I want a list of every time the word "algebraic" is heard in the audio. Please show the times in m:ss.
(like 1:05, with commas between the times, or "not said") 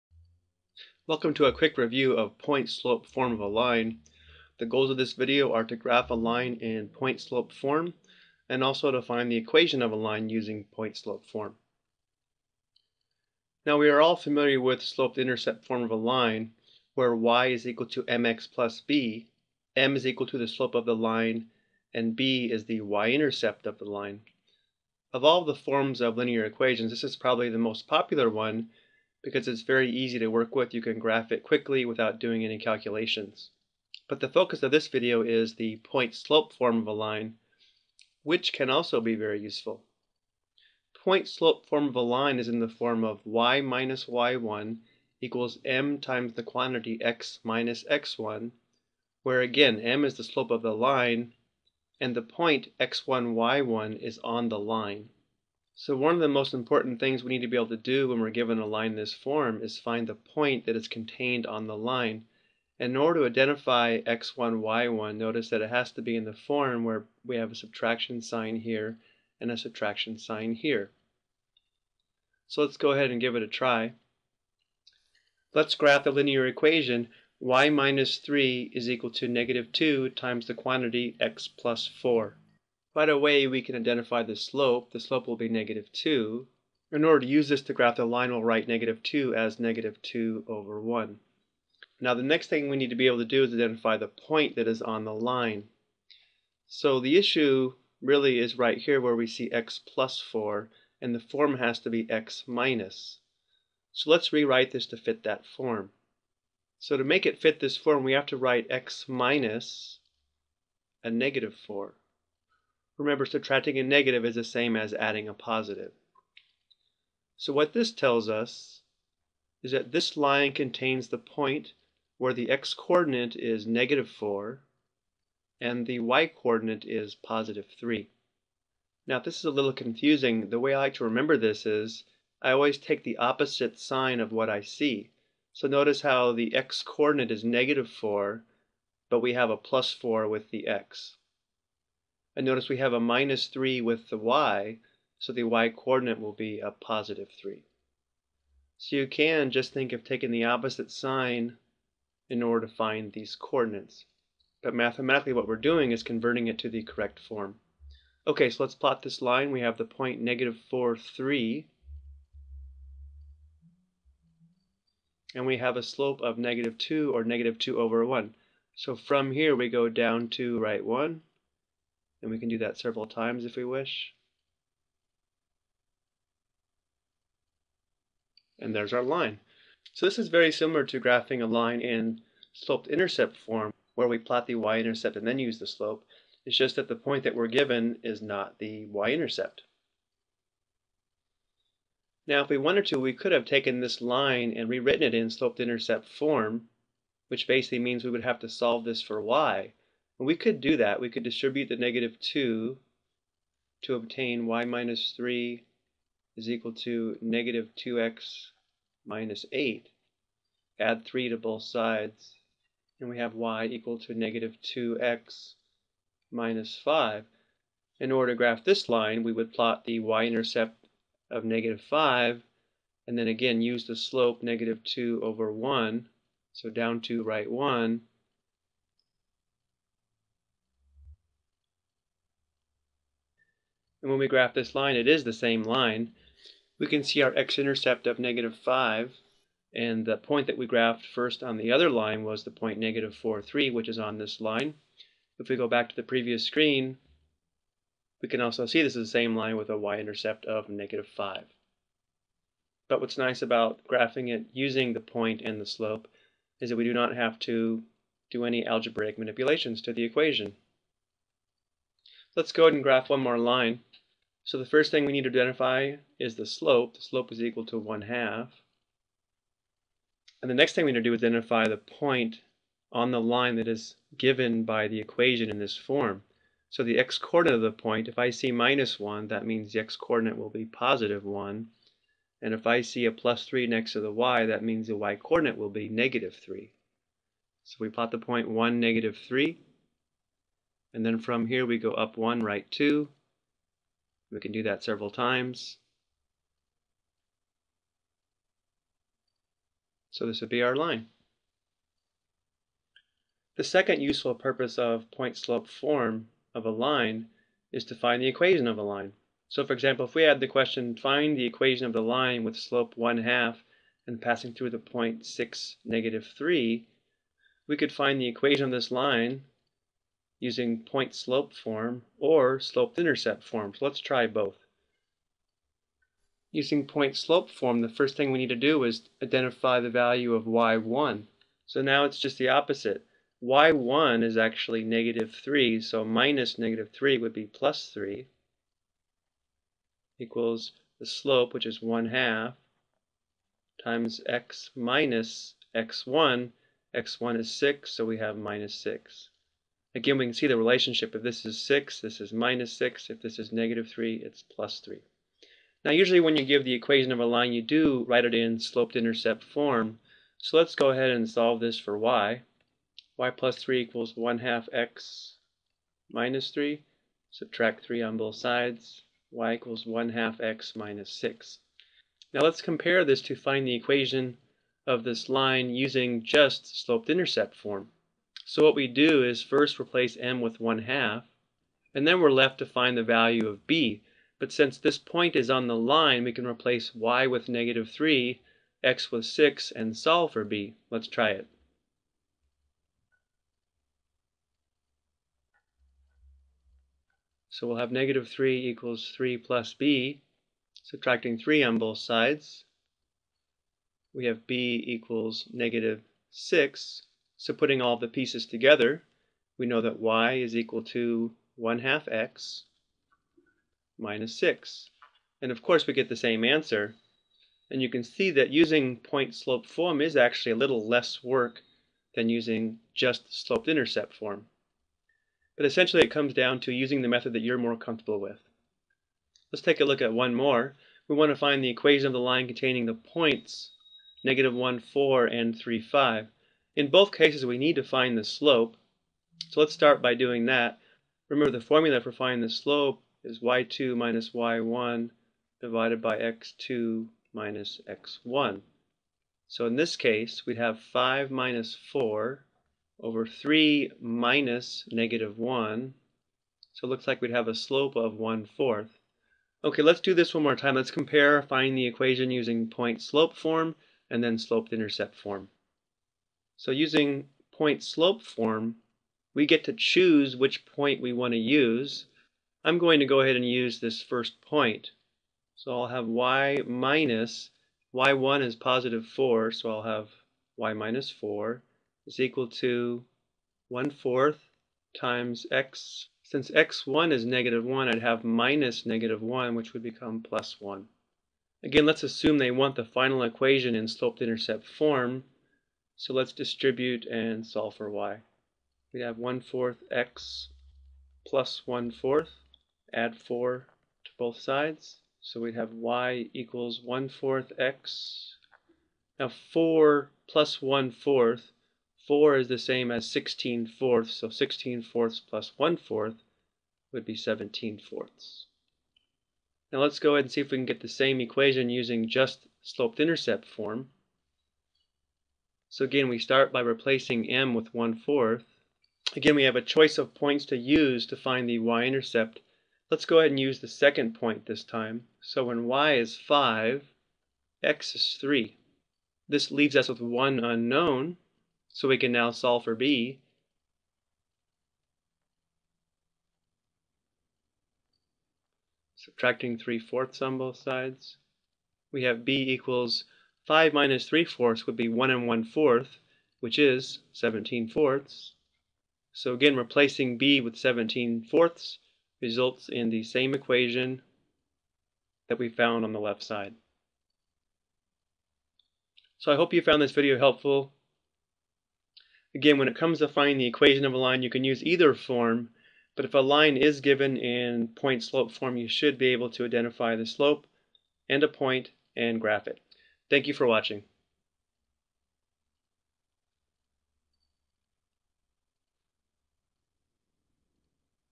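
4:18.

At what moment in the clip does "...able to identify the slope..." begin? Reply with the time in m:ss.
9:39.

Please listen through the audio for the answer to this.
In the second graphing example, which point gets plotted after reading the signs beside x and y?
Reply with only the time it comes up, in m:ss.
4:48.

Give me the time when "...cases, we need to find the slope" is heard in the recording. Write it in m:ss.
7:17.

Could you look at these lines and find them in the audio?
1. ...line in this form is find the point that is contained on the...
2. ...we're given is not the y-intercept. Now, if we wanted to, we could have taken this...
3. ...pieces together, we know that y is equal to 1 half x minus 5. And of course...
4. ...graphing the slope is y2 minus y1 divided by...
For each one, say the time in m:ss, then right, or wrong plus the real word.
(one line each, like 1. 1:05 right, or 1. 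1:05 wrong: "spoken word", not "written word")
1. 0:58 right
2. 3:07 right
3. 6:48 wrong: "6", not "5"
4. 7:22 wrong: "finding", not "graphing".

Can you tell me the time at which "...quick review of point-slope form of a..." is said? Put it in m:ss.
0:01.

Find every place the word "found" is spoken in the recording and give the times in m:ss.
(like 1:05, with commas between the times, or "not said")
9:25, 9:29.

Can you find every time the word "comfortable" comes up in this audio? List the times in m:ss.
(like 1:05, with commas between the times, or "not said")
7:07.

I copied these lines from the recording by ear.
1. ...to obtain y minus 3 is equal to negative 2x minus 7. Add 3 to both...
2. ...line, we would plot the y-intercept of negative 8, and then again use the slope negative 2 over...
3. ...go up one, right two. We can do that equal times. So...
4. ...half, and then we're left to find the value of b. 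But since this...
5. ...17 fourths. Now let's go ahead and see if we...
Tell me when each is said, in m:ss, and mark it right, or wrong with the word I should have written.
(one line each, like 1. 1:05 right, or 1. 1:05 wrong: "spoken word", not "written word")
1. 3:23 wrong: "8", not "7"
2. 3:38 wrong: "5", not "8"
3. 4:51 wrong: "several", not "equal"
4. 6:20 right
5. 8:37 right.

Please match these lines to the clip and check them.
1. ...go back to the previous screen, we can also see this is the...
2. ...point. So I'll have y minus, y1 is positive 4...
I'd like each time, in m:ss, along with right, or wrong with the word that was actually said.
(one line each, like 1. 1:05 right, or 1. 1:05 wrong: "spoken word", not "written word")
1. 4:05 right
2. 7:54 right.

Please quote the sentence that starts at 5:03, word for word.
The second useful purpose of point-slope form of a line is to find the equation of a line.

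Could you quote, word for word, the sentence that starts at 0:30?
You can graph it quickly without doing any calculations.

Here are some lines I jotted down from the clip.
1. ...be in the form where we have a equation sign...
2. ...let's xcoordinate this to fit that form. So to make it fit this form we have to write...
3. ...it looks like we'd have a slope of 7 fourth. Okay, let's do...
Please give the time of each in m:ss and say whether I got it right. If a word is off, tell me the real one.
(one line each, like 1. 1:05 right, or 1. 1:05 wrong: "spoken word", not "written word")
1. 1:06 wrong: "subtraction", not "equation"
2. 1:44 wrong: "rewrite", not "xcoordinate"
3. 7:36 wrong: "1", not "7".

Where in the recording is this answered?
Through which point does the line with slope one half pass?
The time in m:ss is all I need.
5:15.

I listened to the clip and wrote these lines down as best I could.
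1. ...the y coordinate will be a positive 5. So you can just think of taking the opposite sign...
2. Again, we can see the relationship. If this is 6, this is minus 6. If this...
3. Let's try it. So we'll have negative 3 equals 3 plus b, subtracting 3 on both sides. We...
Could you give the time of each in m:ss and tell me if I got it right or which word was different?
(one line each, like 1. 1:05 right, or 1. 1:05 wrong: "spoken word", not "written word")
1. 2:25 wrong: "3", not "5"
2. 5:49 right
3. 6:30 right.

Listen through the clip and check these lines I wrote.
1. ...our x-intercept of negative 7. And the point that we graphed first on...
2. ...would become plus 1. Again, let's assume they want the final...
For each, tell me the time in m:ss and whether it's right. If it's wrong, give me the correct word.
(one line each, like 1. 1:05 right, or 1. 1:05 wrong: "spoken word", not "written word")
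1. 3:57 wrong: "5", not "7"
2. 8:09 right.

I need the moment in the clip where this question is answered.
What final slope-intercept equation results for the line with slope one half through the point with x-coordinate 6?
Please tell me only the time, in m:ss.
6:09.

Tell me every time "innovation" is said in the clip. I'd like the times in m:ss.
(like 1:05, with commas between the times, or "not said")
not said.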